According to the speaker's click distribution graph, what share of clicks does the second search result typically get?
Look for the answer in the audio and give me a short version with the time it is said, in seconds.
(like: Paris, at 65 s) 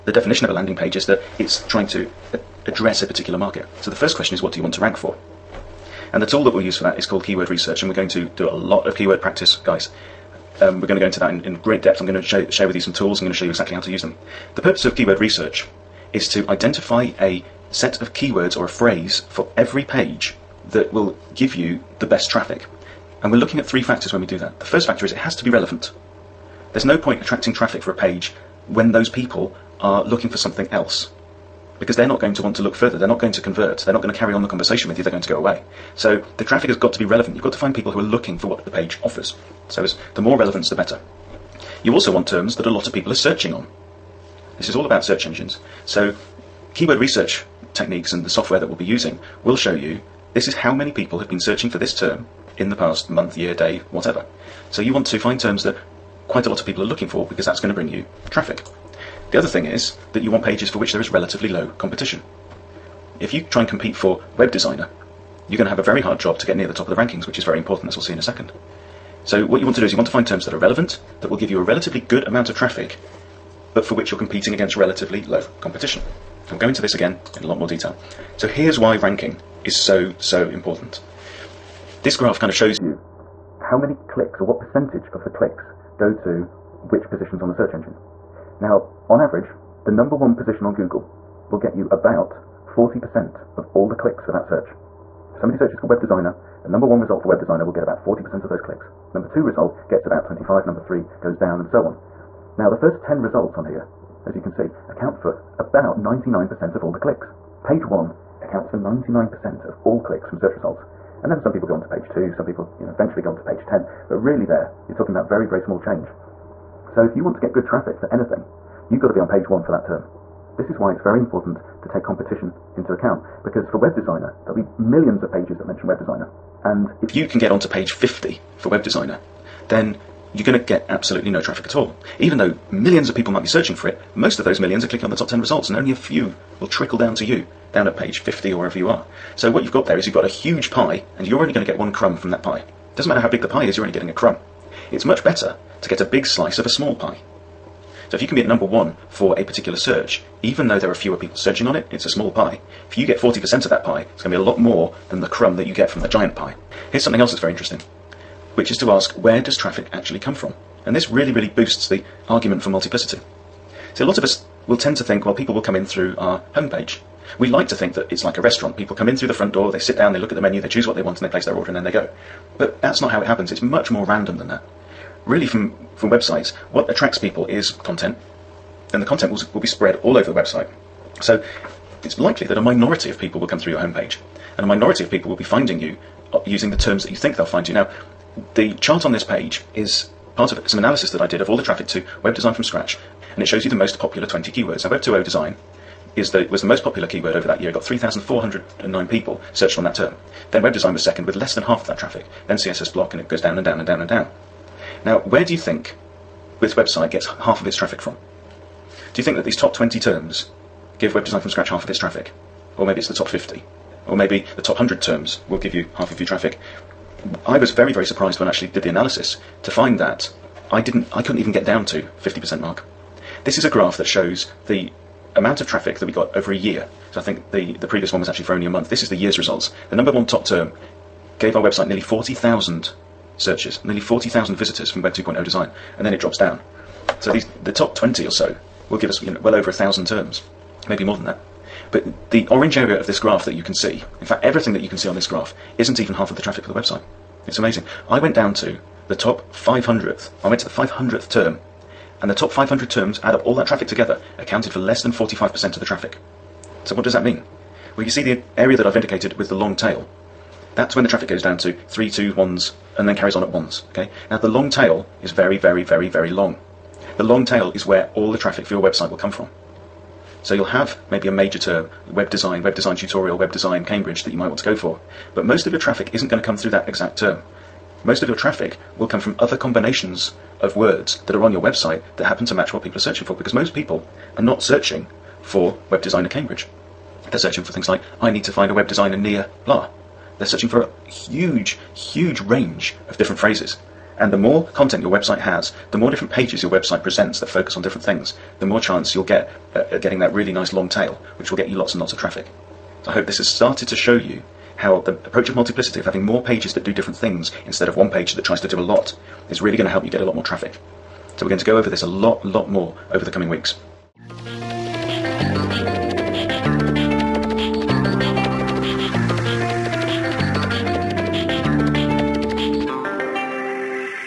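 25%, at 99 s.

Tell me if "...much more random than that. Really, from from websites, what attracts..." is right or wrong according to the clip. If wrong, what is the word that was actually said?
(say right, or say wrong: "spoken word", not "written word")
right.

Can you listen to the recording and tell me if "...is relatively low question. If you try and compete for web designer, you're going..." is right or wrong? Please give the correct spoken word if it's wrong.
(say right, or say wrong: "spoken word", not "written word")
wrong: "competition", not "question".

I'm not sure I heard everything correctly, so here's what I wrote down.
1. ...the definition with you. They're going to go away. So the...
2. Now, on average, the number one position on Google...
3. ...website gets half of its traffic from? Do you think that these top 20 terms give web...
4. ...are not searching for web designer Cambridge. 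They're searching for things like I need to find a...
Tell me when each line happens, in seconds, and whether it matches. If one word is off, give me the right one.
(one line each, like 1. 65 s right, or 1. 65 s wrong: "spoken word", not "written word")
1. 34 s wrong: "conversation", not "definition"
2. 88 s right
3. 206 s right
4. 284 s right.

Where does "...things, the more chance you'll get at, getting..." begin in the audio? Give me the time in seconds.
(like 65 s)
298 s.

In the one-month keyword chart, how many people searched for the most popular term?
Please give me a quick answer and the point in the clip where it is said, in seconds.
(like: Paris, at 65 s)
3,409, at 197 s.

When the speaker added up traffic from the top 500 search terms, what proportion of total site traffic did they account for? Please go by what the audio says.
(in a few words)
less than 45%.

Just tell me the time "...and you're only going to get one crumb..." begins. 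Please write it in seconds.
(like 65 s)
141 s.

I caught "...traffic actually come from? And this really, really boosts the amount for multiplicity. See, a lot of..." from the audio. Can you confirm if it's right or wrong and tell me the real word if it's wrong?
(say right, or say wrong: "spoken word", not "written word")
wrong: "argument", not "amount".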